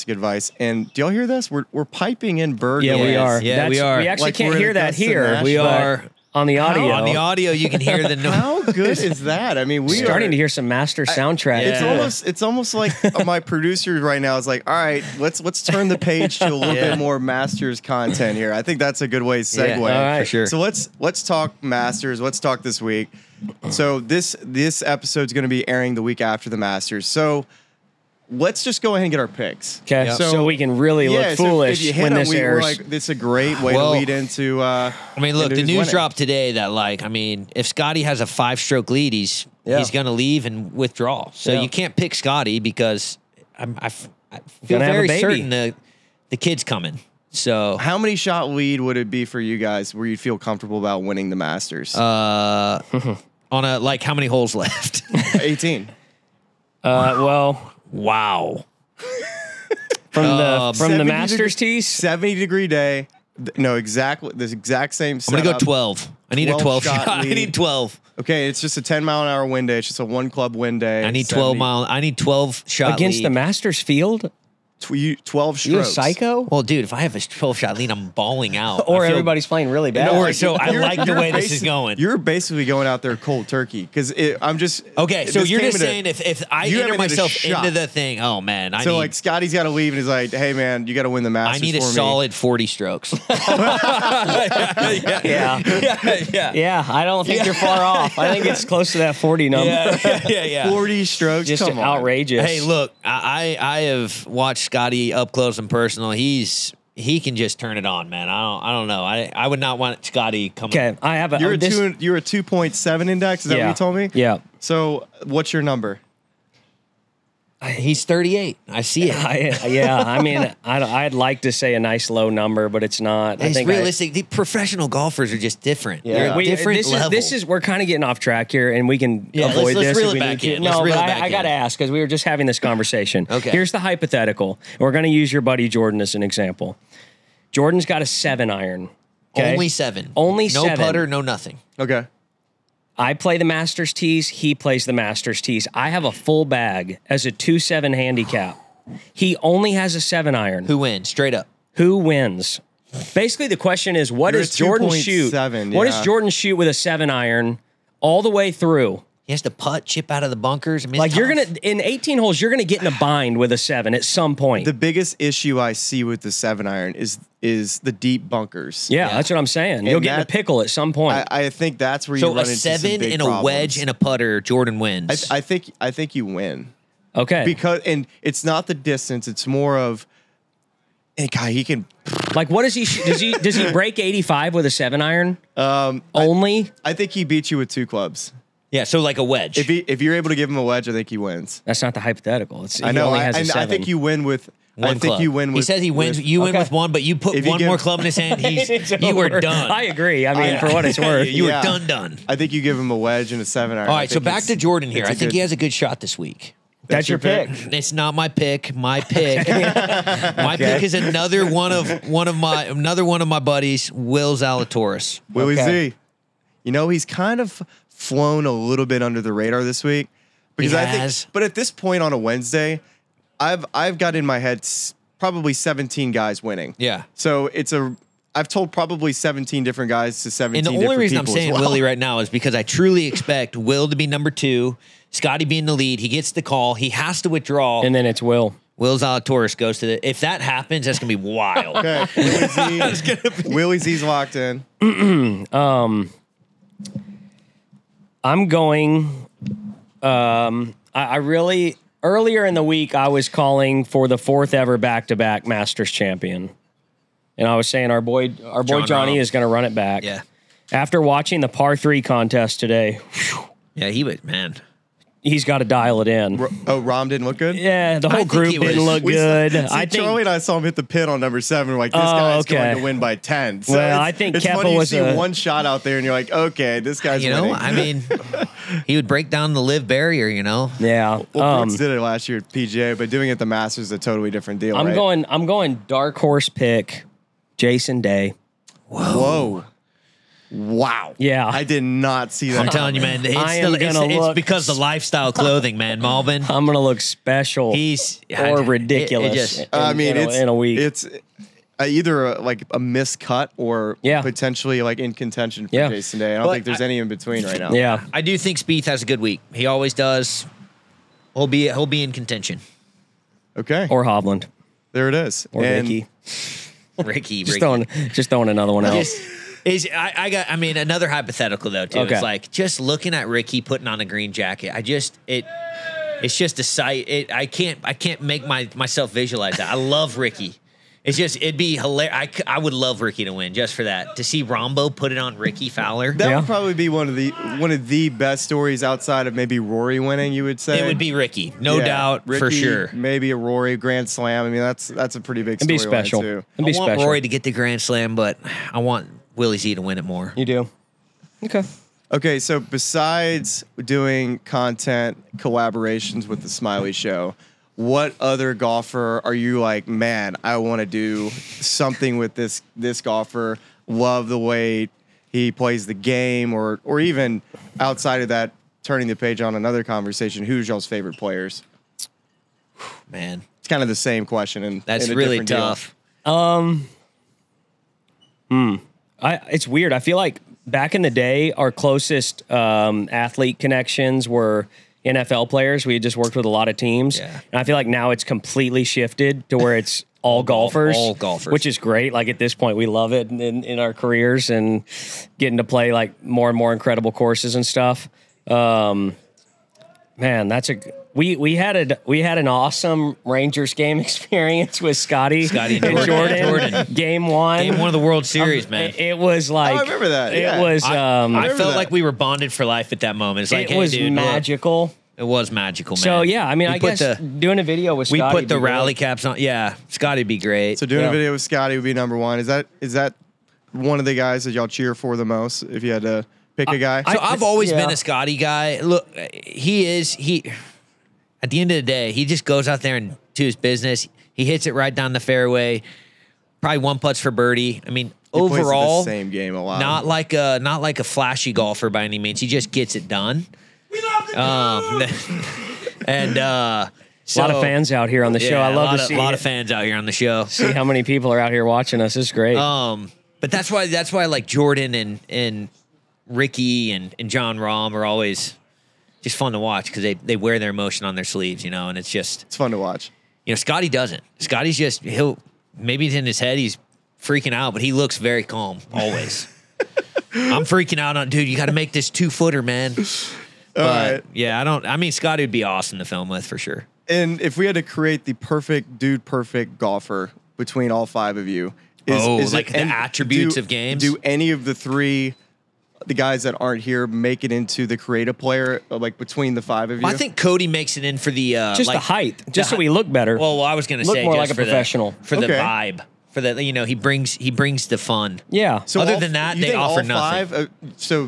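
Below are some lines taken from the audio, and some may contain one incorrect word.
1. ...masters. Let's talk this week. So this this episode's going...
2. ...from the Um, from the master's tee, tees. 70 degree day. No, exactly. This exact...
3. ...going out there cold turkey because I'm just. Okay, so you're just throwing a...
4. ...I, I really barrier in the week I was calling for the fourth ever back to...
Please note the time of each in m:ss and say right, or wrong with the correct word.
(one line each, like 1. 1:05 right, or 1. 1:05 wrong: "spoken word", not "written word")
1. 0:21 right
2. 1:00 right
3. 1:22 wrong: "saying", not "throwing"
4. 4:10 wrong: "earlier", not "barrier".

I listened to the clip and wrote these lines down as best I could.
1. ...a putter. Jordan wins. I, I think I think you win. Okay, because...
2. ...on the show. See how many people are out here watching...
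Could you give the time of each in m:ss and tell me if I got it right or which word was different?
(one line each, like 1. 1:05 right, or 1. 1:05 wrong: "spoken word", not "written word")
1. 2:53 right
2. 7:29 right.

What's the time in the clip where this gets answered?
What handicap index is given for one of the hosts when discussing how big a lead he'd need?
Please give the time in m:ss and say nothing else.
1:52.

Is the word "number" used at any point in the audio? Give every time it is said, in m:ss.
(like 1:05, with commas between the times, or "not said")
1:39, 1:55, 2:02, 3:54, 4:31, 7:01.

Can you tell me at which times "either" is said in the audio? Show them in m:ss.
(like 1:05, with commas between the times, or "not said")
5:01.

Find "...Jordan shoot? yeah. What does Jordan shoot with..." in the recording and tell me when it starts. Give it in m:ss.
2:34.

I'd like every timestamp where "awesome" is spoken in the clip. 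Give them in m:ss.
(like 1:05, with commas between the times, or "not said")
6:42, 7:55.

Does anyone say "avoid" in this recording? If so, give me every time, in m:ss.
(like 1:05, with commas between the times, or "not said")
2:09.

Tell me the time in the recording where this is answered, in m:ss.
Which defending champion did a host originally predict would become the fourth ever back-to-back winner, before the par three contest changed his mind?
4:18.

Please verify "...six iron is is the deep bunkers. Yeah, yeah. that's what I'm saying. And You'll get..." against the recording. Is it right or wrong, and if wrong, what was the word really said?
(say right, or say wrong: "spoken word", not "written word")
wrong: "seven", not "six".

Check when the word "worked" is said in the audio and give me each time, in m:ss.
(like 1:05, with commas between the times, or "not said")
6:26.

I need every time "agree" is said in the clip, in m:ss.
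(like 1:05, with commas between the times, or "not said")
3:19.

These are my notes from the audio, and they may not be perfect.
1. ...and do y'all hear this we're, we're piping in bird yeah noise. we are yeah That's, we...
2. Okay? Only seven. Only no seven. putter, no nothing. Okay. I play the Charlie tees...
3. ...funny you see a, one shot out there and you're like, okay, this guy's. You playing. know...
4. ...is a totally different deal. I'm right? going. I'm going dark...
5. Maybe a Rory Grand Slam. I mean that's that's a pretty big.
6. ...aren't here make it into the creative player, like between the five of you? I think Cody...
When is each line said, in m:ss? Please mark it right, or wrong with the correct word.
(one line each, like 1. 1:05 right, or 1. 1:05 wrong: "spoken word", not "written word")
1. 0:00 right
2. 2:19 wrong: "Masters", not "Charlie"
3. 4:34 wrong: "winning", not "playing"
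4. 4:43 right
5. 5:42 right
6. 8:06 right.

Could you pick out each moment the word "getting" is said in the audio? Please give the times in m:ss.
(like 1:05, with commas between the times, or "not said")
2:07, 6:35.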